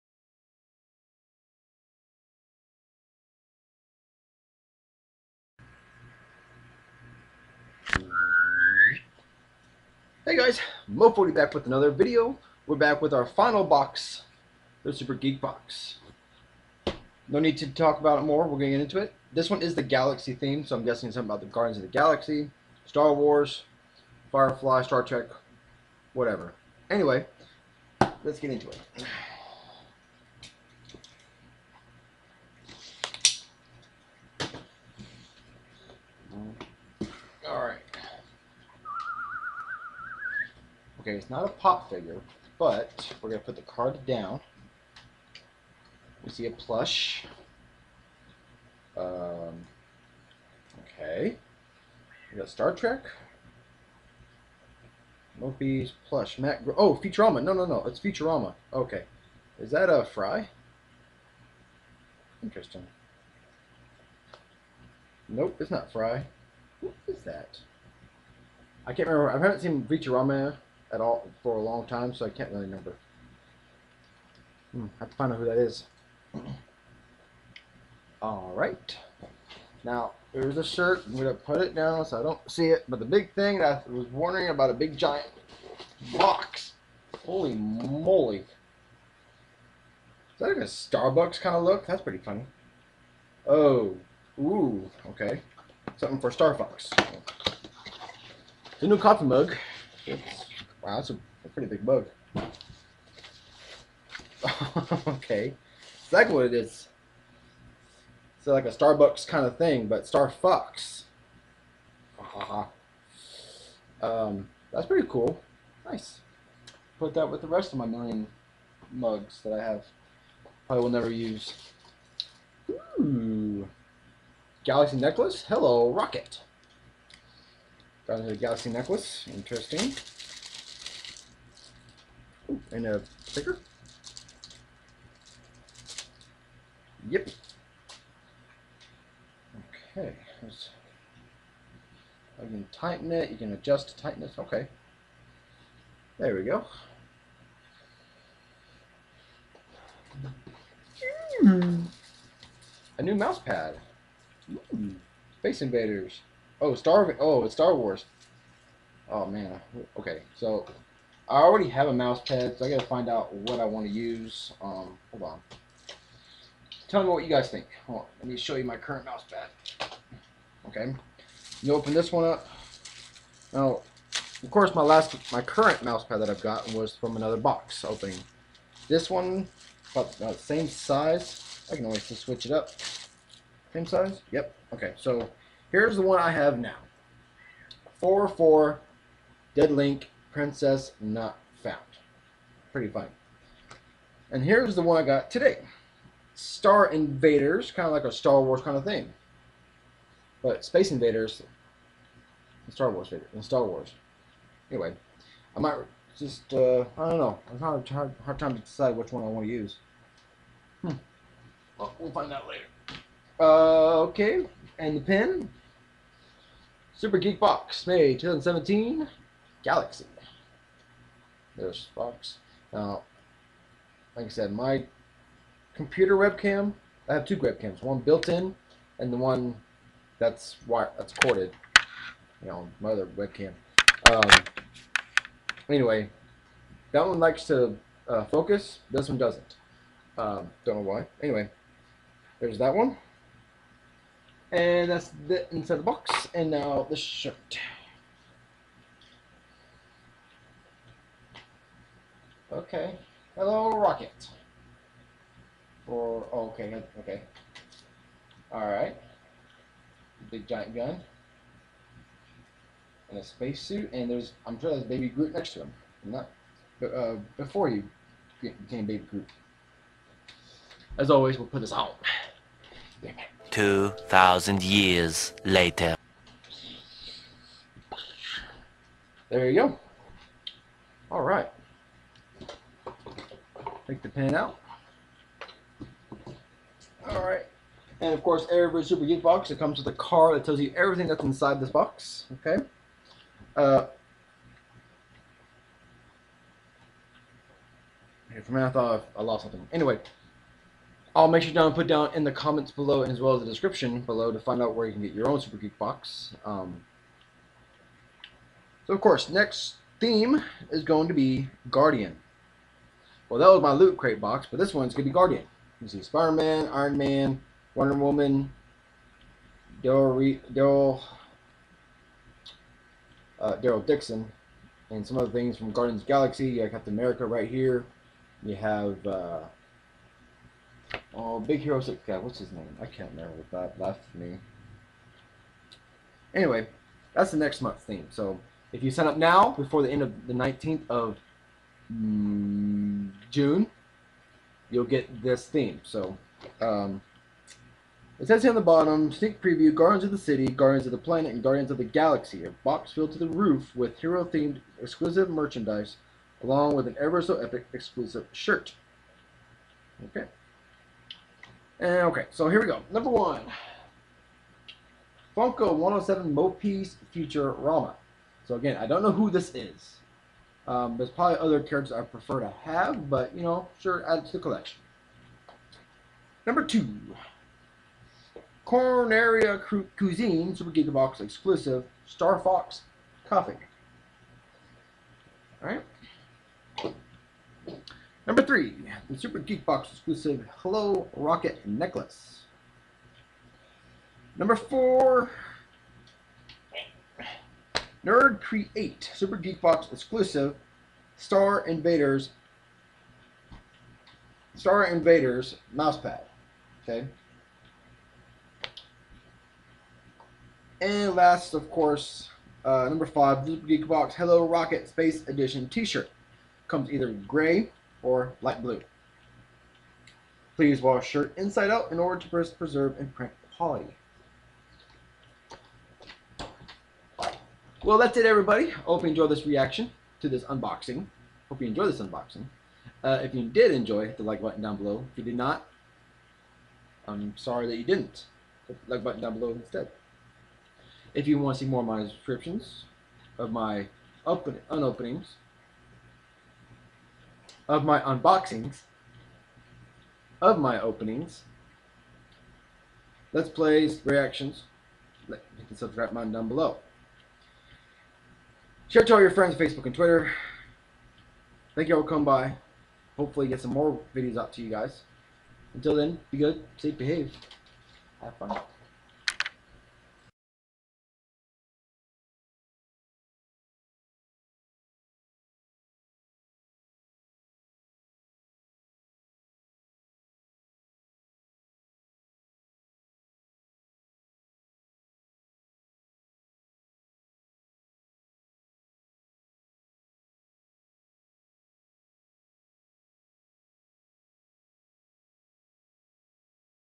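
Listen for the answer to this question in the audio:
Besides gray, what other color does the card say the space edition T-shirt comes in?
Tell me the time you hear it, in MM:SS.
06:58.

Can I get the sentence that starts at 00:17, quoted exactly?
No need to talk about it more, we're going to get into it.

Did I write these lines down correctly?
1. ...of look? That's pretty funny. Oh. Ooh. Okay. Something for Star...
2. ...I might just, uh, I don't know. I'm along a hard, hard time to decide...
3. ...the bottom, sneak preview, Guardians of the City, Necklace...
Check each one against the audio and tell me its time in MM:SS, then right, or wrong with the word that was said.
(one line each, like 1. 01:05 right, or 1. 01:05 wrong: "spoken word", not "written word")
1. 01:31 right
2. 03:25 wrong: "having", not "along"
3. 05:48 wrong: "Guardians", not "Necklace".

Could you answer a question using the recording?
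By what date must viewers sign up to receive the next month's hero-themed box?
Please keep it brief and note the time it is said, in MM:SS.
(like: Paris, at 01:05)
June 19, at 05:40.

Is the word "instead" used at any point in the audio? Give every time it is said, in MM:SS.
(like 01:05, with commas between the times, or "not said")
07:19.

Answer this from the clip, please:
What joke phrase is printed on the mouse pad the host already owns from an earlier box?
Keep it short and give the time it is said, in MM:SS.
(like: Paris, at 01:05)
Dead Link Princess Not Found, at 03:09.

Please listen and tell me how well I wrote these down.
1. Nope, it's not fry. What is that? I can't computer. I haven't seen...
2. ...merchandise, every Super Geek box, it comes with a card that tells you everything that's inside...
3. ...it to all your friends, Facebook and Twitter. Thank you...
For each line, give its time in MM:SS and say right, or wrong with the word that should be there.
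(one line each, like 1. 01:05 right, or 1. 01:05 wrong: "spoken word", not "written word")
1. 01:05 wrong: "remember", not "computer"
2. 04:48 wrong: "course", not "merchandise"
3. 07:39 right.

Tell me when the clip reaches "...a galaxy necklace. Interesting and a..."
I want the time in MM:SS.
02:08.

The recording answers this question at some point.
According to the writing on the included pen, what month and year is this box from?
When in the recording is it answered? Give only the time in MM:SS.
03:37.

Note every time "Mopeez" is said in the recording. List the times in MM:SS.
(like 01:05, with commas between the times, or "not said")
00:55.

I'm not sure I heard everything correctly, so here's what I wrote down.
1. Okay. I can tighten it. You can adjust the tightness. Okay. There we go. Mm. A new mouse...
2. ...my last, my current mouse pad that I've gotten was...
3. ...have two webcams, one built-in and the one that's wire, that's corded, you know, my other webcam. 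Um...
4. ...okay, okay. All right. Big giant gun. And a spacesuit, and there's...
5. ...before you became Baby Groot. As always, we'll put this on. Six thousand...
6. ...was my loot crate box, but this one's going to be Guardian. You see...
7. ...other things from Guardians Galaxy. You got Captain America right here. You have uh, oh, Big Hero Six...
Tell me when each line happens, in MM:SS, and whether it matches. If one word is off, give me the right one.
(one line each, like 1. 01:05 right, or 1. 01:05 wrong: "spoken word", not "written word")
1. 02:19 right
2. 02:54 right
3. 03:47 right
4. 04:16 right
5. 04:27 wrong: "Two", not "Six"
6. 05:13 right
7. 05:25 right.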